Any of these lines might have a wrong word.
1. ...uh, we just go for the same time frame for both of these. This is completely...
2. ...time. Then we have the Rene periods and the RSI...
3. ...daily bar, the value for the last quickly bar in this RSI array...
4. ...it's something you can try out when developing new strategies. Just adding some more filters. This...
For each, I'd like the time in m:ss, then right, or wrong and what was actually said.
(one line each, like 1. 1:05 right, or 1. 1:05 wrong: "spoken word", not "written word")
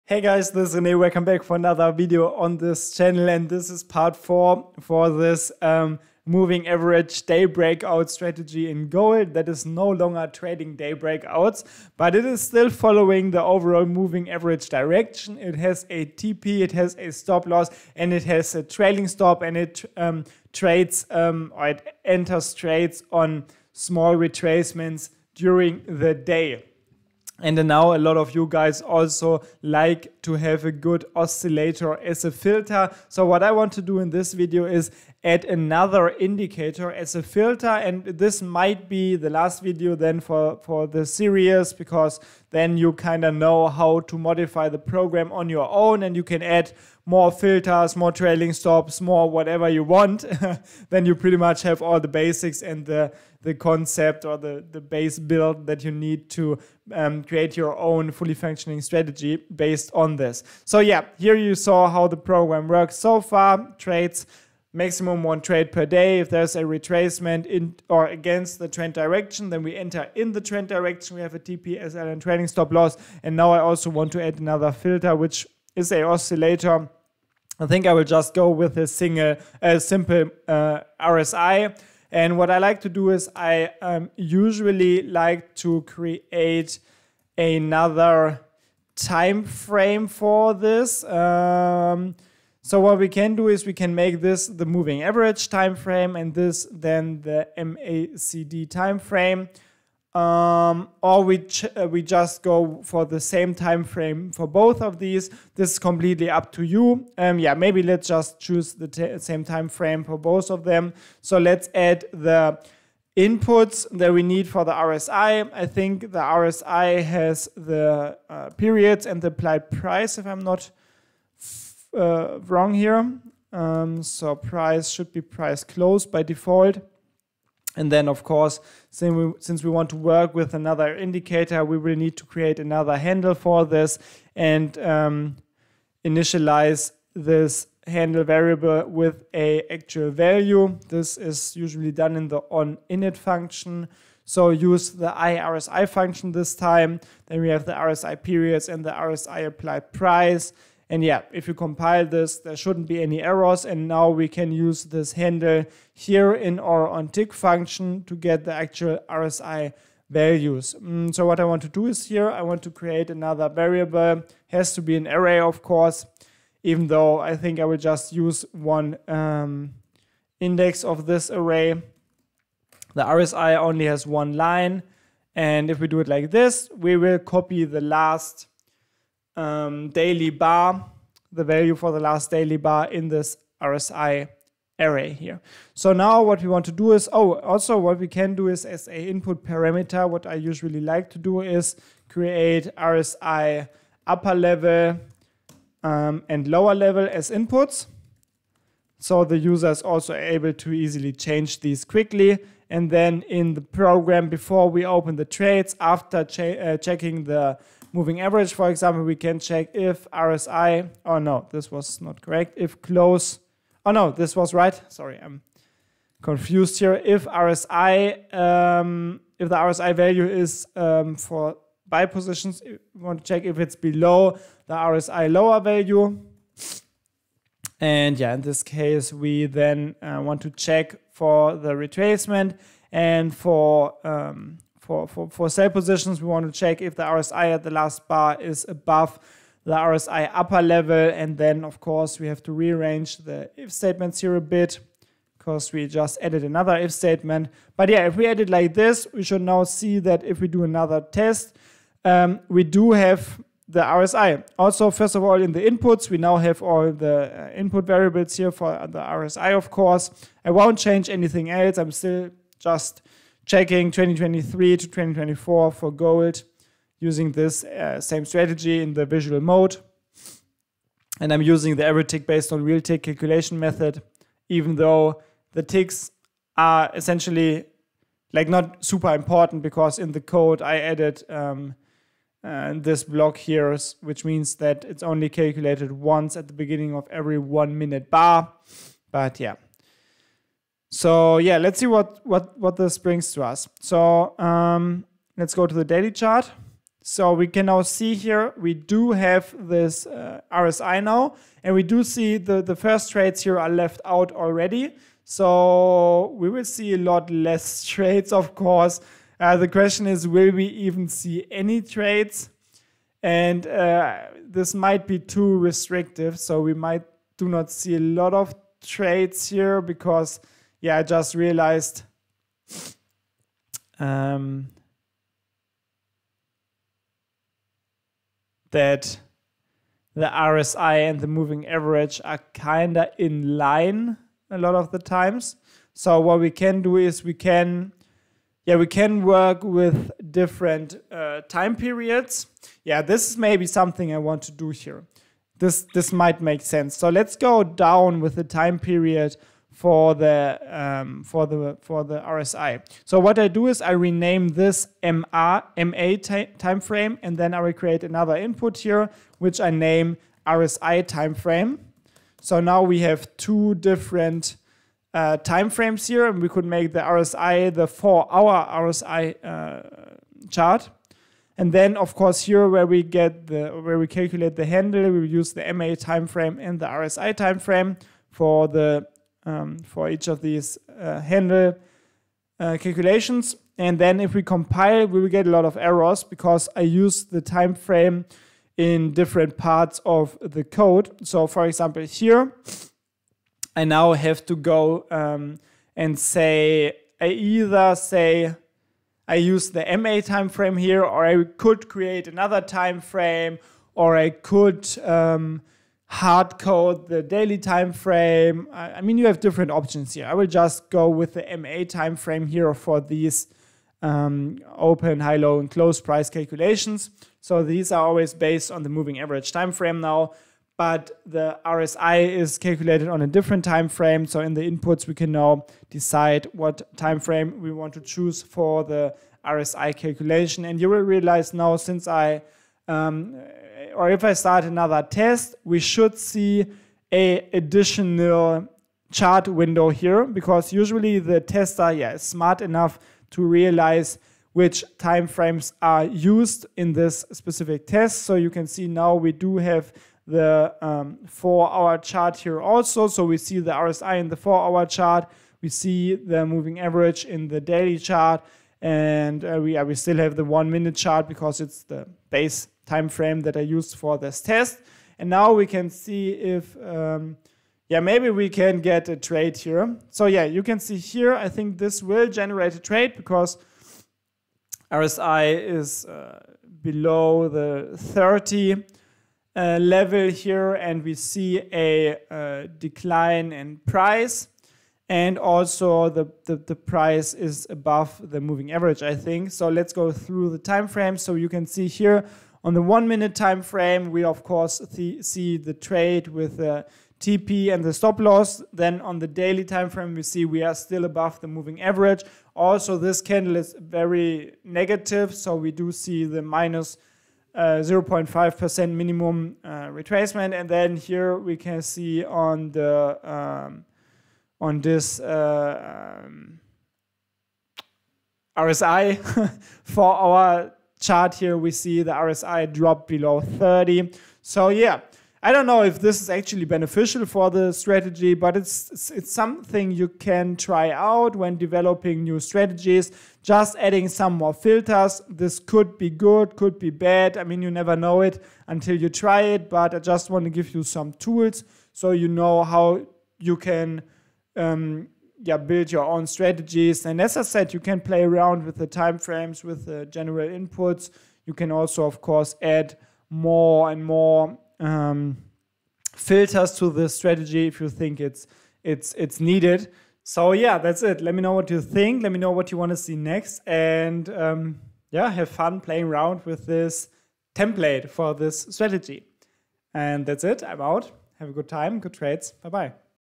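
1. 1:41 right
2. 2:26 wrong: "RSI", not "Rene"
3. 2:59 wrong: "daily", not "quickly"
4. 8:49 right.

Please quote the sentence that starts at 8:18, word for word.
Then on the daily time frame, we see we are still above the moving average.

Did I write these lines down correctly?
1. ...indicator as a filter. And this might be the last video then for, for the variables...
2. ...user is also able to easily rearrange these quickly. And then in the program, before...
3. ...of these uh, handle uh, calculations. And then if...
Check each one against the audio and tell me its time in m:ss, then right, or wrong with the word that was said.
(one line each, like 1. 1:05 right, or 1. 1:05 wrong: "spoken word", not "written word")
1. 0:36 wrong: "series", not "variables"
2. 3:19 wrong: "change", not "rearrange"
3. 6:20 right.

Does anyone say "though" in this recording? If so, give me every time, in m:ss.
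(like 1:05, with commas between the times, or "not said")
2:46, 4:34.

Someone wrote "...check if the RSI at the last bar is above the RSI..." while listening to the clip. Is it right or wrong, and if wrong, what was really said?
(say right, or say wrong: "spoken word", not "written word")
right.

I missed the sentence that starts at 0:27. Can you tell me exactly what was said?
And now a lot of you guys also like to have a good oscillator as a filter.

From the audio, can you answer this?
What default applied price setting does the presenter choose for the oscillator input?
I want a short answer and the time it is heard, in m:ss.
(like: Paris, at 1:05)
Price close, at 2:05.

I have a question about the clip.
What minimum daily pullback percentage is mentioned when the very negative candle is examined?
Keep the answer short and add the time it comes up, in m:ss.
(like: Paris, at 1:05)
0.5%, at 8:27.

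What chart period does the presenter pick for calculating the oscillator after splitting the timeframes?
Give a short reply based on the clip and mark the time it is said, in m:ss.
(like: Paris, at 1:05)
Four-hour, at 6:07.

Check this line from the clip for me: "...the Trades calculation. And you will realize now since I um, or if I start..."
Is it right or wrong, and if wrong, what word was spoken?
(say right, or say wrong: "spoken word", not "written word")
wrong: "RSI", not "Trades".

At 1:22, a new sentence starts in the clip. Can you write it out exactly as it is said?
And what I like to do is I um, usually like to create another time frame for this.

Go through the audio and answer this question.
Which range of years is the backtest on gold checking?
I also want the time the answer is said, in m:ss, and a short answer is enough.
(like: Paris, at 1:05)
2023 to 2024, at 4:23.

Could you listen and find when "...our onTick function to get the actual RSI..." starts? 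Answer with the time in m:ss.
2:36.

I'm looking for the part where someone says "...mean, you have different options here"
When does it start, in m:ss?
6:49.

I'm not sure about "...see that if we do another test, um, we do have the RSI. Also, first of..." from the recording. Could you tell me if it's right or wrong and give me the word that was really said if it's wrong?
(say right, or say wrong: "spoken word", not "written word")
right.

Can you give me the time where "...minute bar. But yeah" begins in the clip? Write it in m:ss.
4:47.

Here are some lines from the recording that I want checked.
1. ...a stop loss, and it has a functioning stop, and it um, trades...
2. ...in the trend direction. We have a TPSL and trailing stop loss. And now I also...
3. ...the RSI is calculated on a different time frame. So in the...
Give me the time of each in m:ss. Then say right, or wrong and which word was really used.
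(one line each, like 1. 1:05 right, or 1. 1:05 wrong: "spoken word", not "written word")
1. 0:16 wrong: "trailing", not "functioning"
2. 1:10 right
3. 7:01 right.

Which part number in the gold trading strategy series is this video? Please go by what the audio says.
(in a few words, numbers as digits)
4.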